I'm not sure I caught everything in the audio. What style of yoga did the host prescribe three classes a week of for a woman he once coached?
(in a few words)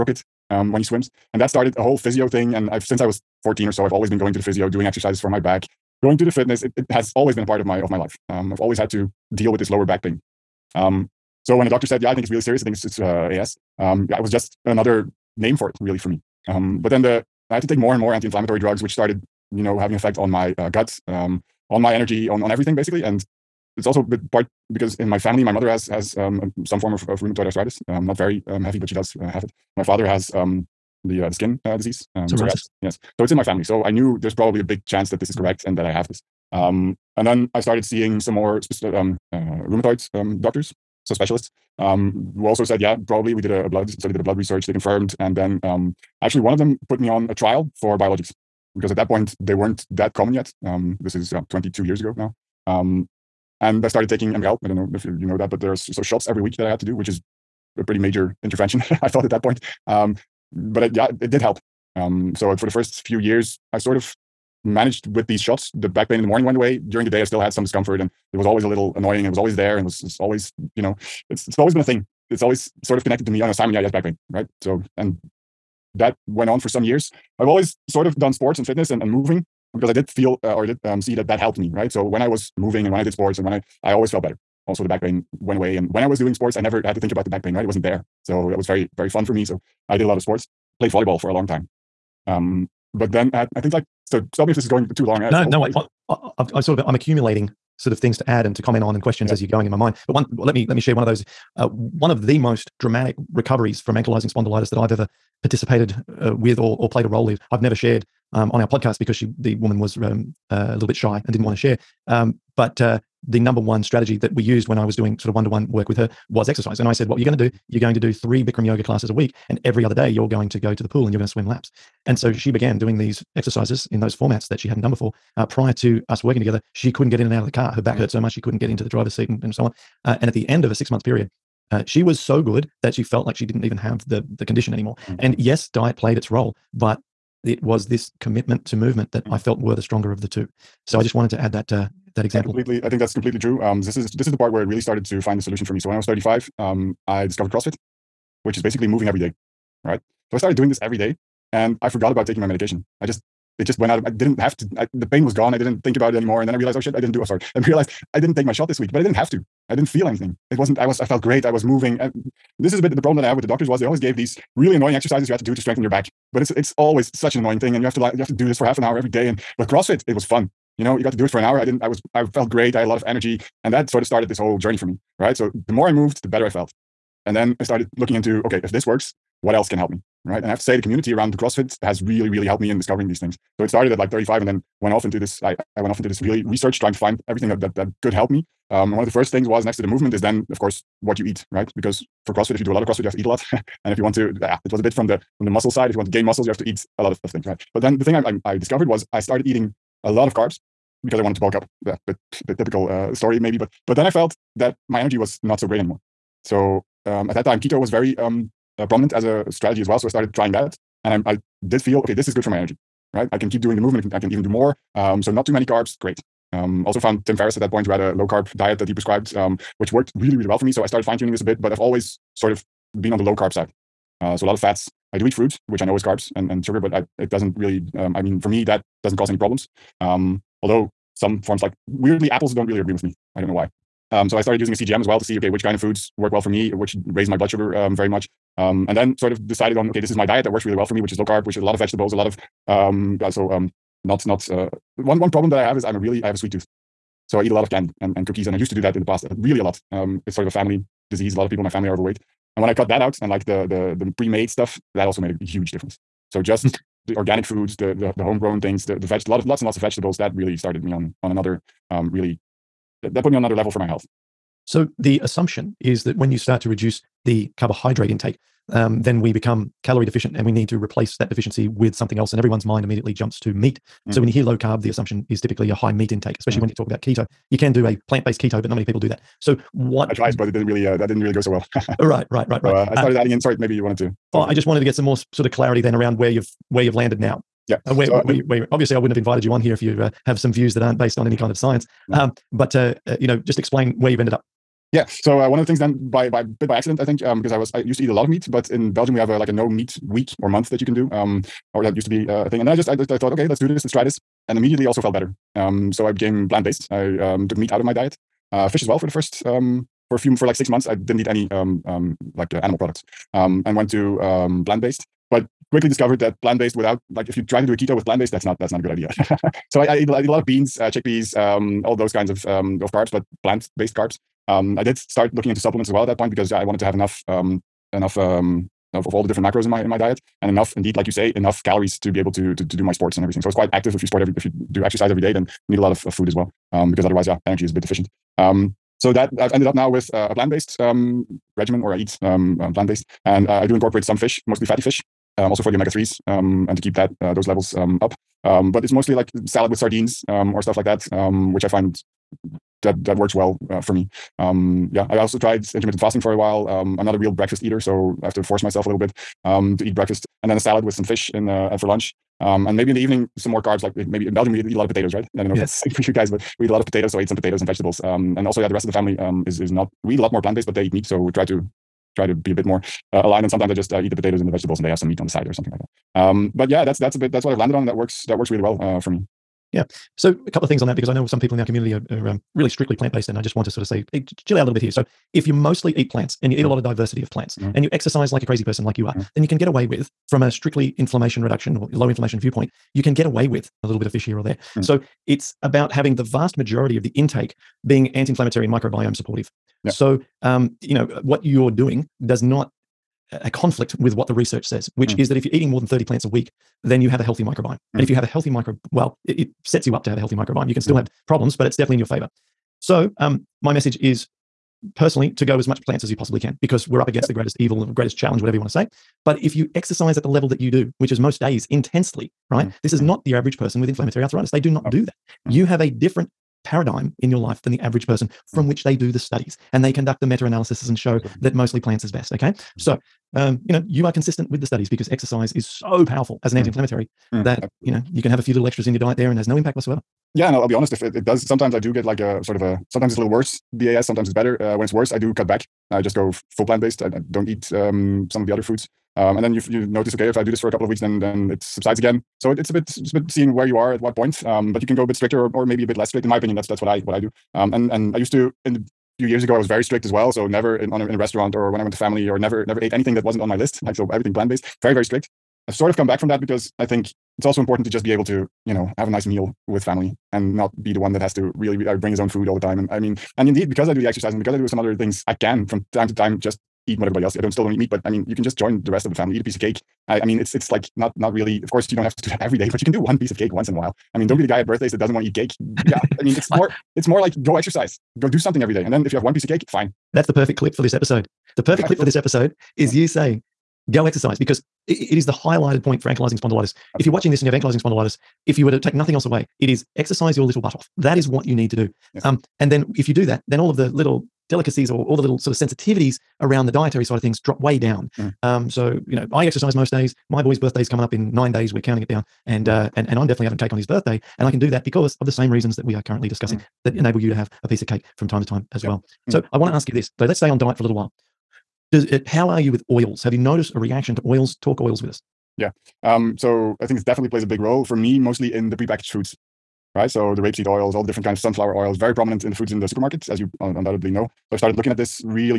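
Bikram yoga.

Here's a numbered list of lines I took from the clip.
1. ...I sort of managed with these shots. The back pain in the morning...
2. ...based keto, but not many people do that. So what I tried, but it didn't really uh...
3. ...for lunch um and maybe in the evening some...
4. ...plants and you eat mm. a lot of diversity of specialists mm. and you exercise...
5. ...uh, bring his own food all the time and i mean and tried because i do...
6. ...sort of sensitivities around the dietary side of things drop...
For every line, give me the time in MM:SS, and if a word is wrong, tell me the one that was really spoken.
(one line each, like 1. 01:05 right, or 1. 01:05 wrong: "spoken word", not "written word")
1. 01:03 right
2. 04:38 right
3. 06:01 right
4. 06:26 wrong: "plants", not "specialists"
5. 07:51 wrong: "indeed", not "tried"
6. 08:25 right.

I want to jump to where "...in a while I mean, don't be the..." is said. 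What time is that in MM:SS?
08:03.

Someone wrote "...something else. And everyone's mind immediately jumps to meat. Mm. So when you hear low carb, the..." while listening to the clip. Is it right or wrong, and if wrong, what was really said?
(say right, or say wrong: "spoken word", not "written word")
right.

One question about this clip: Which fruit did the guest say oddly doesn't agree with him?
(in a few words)
apples.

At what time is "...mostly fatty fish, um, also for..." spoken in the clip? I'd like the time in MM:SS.
05:44.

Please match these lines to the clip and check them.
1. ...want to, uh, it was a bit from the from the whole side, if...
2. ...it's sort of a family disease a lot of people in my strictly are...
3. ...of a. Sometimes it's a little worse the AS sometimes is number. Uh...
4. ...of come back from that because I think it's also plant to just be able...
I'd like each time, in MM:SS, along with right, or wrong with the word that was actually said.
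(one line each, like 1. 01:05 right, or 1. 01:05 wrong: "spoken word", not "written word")
1. 03:14 wrong: "muscle", not "whole"
2. 04:10 wrong: "family", not "strictly"
3. 07:22 wrong: "better", not "number"
4. 07:45 wrong: "important", not "plant".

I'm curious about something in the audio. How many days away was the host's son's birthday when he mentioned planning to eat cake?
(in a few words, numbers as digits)
9.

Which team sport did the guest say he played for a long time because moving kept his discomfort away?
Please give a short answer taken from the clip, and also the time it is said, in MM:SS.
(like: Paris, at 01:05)
volleyball, at 01:30.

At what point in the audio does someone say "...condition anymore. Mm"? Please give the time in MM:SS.
02:14.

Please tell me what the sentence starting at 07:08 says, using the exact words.
which they do the studies and they conduct the meta analysis and show that mostly plants is best.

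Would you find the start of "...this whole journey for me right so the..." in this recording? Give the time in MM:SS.
02:54.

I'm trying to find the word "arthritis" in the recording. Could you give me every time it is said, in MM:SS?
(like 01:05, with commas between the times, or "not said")
00:27, 07:04.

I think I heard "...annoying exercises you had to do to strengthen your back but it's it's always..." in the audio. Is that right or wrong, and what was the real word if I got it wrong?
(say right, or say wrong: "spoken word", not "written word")
right.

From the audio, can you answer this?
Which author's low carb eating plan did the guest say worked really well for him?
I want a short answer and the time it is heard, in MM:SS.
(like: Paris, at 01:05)
Tim Ferriss, at 03:37.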